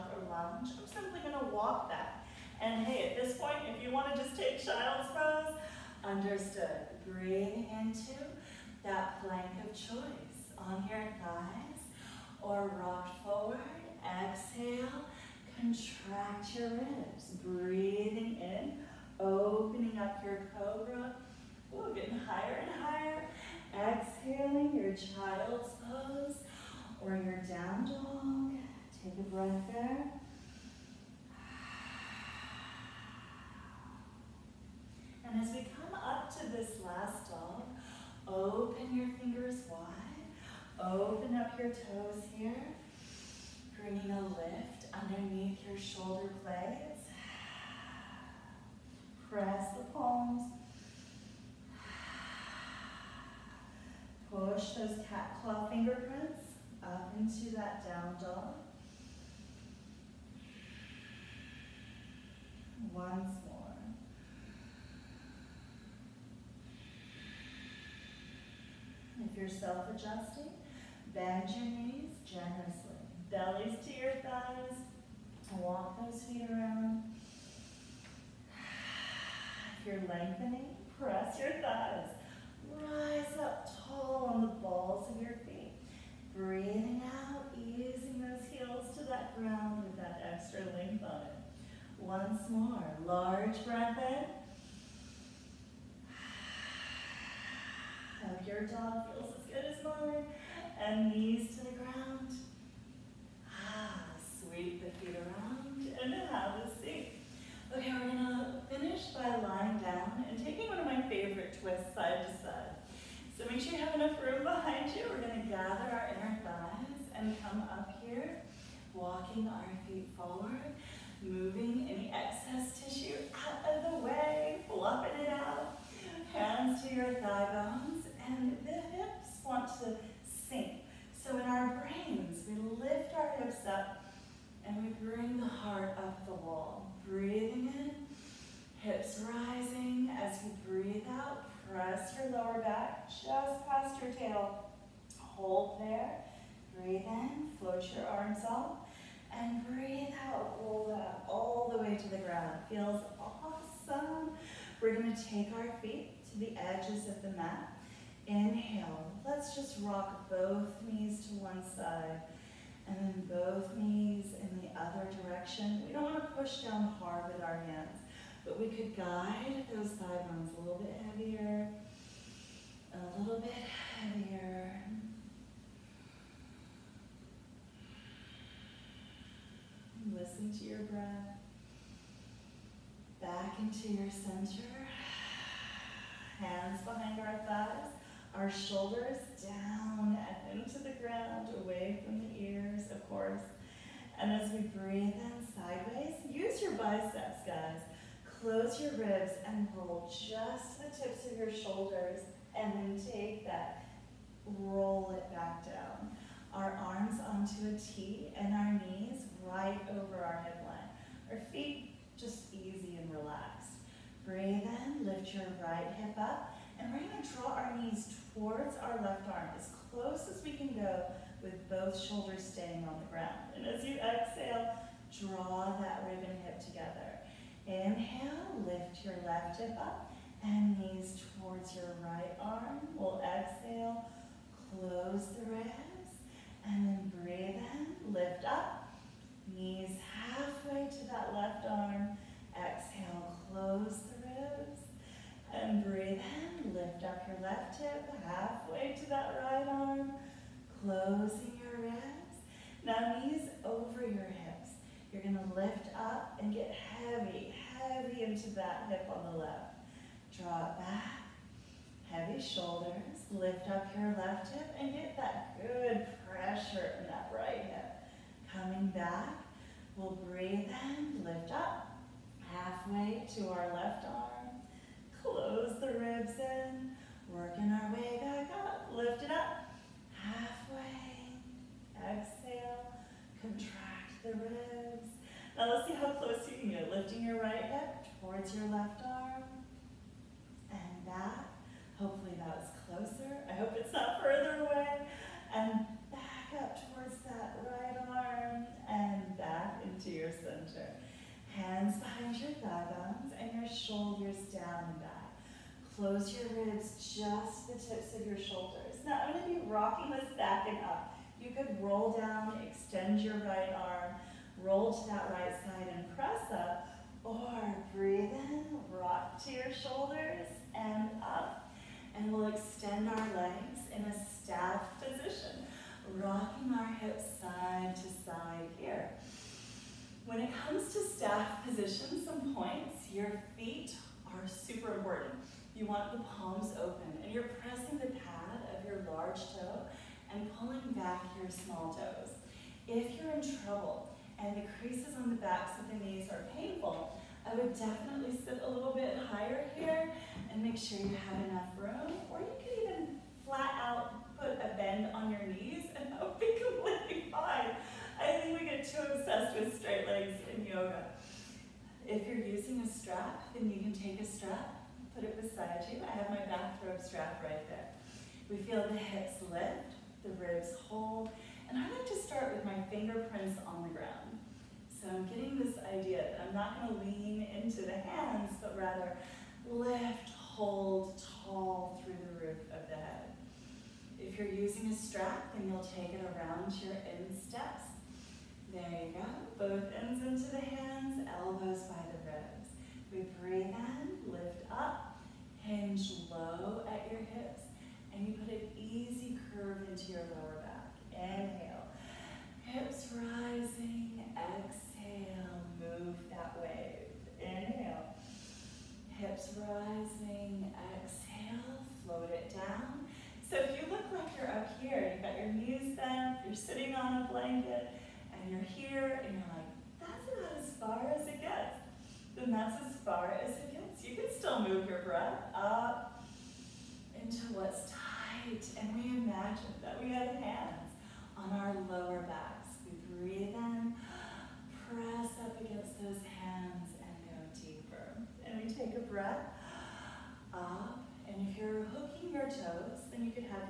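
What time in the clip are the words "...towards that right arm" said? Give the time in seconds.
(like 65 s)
296 s.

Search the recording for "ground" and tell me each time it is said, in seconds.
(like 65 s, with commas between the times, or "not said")
89 s, 101 s, 152 s, 190 s, 223 s, 373 s.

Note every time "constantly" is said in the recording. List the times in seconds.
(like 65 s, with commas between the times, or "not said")
not said.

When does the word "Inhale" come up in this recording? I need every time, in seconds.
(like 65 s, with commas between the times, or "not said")
158 s, 227 s, 401 s, 407 s.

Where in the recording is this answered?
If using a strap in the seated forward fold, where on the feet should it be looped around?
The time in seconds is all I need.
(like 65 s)
387 s.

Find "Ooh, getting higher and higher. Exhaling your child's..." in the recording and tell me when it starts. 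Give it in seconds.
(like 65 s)
21 s.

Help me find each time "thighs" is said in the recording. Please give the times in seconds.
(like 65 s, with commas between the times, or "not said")
11 s, 74 s, 81 s, 116 s, 127 s, 169 s, 187 s, 302 s.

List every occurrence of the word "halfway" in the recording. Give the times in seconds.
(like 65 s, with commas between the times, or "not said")
240 s, 248 s, 272 s, 280 s.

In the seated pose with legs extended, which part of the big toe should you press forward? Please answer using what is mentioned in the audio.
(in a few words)
the pad.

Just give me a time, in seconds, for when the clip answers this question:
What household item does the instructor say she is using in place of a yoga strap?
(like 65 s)
366 s.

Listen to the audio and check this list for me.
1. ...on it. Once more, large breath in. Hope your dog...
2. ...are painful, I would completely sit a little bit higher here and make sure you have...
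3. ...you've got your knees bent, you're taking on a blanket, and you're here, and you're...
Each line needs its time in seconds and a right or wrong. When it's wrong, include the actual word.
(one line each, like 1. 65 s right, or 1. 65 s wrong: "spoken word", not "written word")
1. 91 s right
2. 346 s wrong: "definitely", not "completely"
3. 415 s wrong: "sitting", not "taking".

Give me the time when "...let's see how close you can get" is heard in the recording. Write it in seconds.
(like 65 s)
285 s.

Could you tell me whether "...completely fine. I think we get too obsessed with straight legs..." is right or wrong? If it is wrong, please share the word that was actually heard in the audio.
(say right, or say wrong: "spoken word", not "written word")
right.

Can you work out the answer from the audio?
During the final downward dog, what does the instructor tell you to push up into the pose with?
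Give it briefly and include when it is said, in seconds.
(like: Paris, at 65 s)
cat claw fingerprints, at 55 s.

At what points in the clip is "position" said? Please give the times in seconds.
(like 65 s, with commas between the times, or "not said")
325 s, 331 s.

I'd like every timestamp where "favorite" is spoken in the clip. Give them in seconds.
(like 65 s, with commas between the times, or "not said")
111 s.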